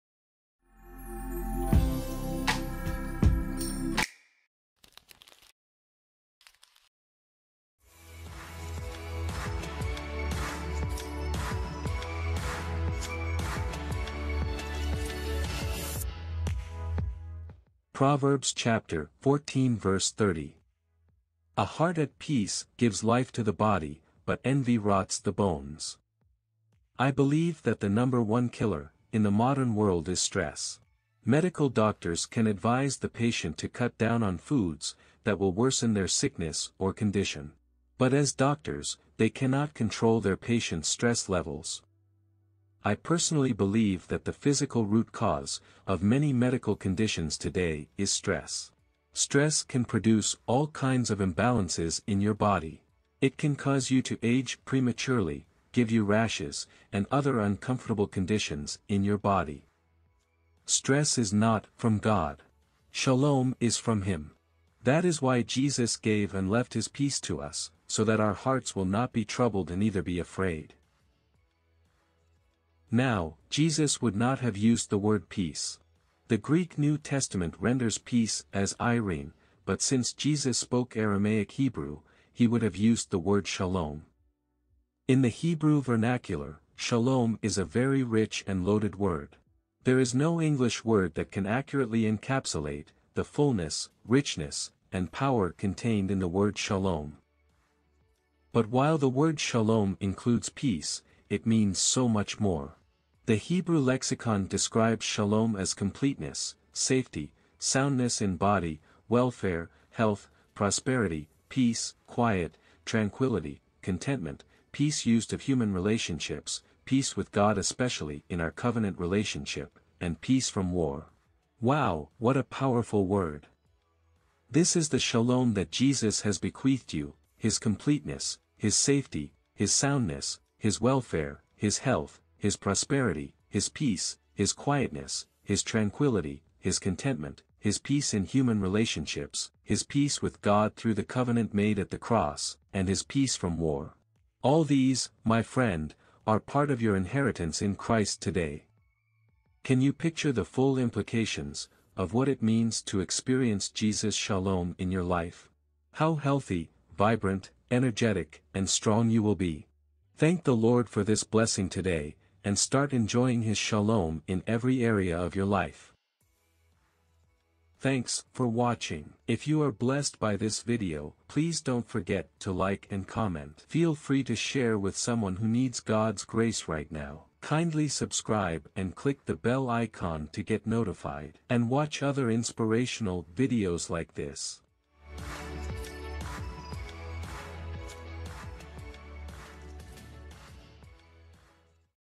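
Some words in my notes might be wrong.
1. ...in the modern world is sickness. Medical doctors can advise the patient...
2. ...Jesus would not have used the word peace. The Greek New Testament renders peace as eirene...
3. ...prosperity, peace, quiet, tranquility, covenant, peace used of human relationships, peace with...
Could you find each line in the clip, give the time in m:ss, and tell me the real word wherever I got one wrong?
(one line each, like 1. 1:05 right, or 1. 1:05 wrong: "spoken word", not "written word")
1. 0:29 wrong: "stress", not "sickness"
2. 1:13 right
3. 1:50 wrong: "contentment", not "covenant".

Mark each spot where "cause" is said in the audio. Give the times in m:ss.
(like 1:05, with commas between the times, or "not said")
0:45, 0:53.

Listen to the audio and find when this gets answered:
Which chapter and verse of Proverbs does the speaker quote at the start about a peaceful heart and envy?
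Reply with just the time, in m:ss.
0:18.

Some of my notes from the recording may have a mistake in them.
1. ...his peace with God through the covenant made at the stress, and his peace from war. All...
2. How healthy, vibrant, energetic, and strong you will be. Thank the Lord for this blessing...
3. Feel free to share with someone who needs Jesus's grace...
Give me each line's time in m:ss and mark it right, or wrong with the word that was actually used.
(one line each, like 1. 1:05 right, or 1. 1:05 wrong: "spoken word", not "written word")
1. 2:19 wrong: "cross", not "stress"
2. 2:35 right
3. 2:53 wrong: "God", not "Jesus".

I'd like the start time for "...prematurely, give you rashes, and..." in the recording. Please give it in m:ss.
0:54.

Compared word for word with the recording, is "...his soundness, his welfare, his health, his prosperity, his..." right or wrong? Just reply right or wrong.
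right.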